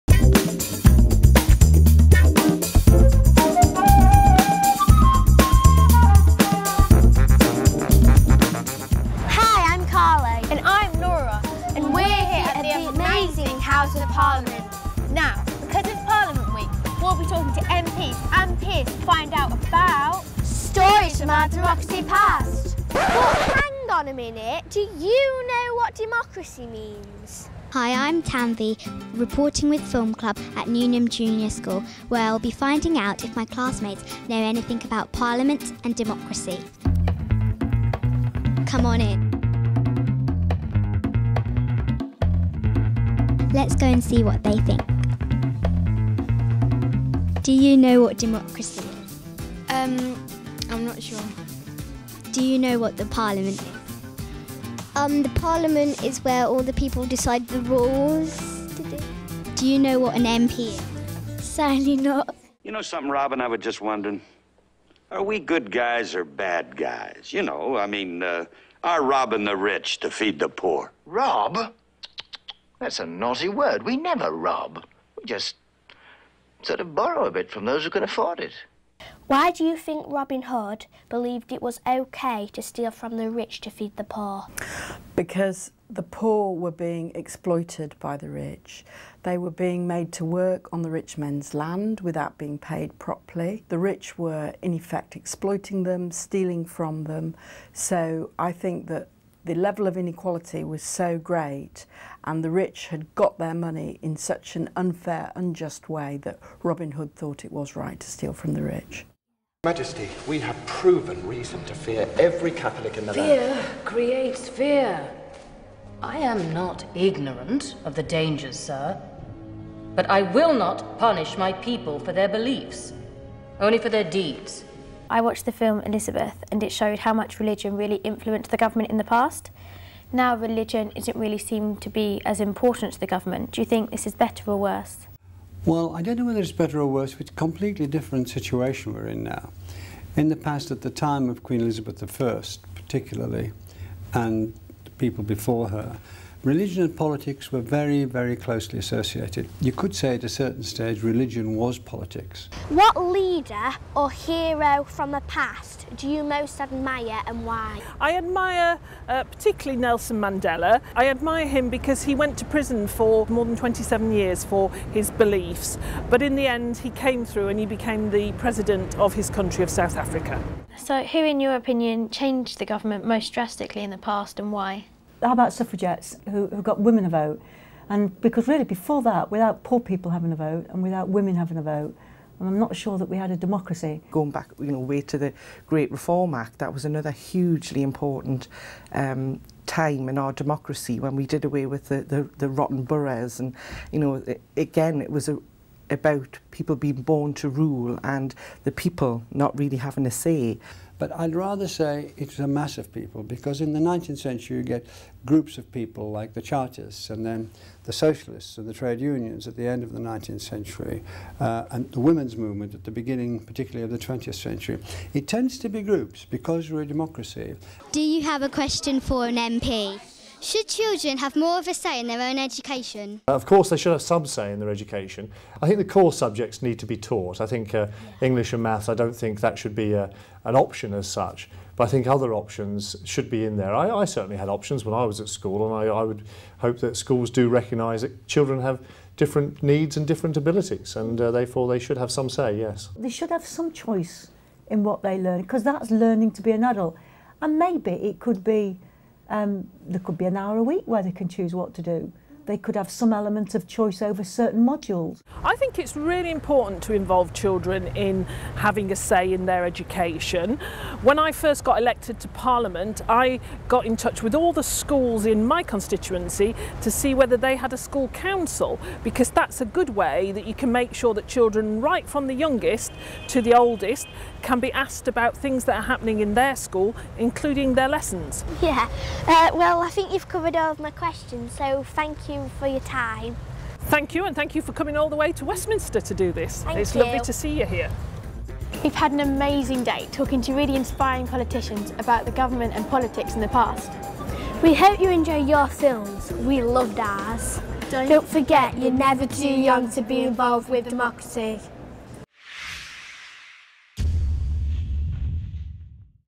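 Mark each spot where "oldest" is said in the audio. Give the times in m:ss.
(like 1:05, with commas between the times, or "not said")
4:33.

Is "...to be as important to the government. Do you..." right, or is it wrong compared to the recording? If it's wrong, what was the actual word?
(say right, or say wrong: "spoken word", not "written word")
right.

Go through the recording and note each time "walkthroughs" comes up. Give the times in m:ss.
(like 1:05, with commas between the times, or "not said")
not said.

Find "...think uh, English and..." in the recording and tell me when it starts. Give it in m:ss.
3:47.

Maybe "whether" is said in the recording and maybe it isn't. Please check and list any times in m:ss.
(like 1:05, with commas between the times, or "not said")
2:16, 4:27.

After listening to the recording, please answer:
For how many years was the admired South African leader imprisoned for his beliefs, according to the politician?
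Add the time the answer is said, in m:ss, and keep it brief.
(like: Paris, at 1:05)
More than 27, at 2:43.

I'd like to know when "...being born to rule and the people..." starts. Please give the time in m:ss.
3:16.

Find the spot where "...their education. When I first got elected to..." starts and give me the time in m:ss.
4:19.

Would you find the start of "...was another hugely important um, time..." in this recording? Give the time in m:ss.
3:06.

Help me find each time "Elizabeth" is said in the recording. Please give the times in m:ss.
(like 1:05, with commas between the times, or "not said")
2:05, 2:21.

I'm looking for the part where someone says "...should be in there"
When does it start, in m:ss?
3:53.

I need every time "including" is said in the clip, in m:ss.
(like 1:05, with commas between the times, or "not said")
4:37.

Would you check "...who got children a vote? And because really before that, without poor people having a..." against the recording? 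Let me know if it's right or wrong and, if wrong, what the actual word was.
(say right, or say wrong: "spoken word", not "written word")
wrong: "women", not "children".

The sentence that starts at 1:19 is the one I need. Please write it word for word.
Why do you think Robin Hood believed it was okay to steal from the rich to feed the poor?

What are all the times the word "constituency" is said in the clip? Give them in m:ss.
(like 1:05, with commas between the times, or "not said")
4:25.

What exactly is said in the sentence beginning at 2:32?
What leader or hero from the past do you most admire and why?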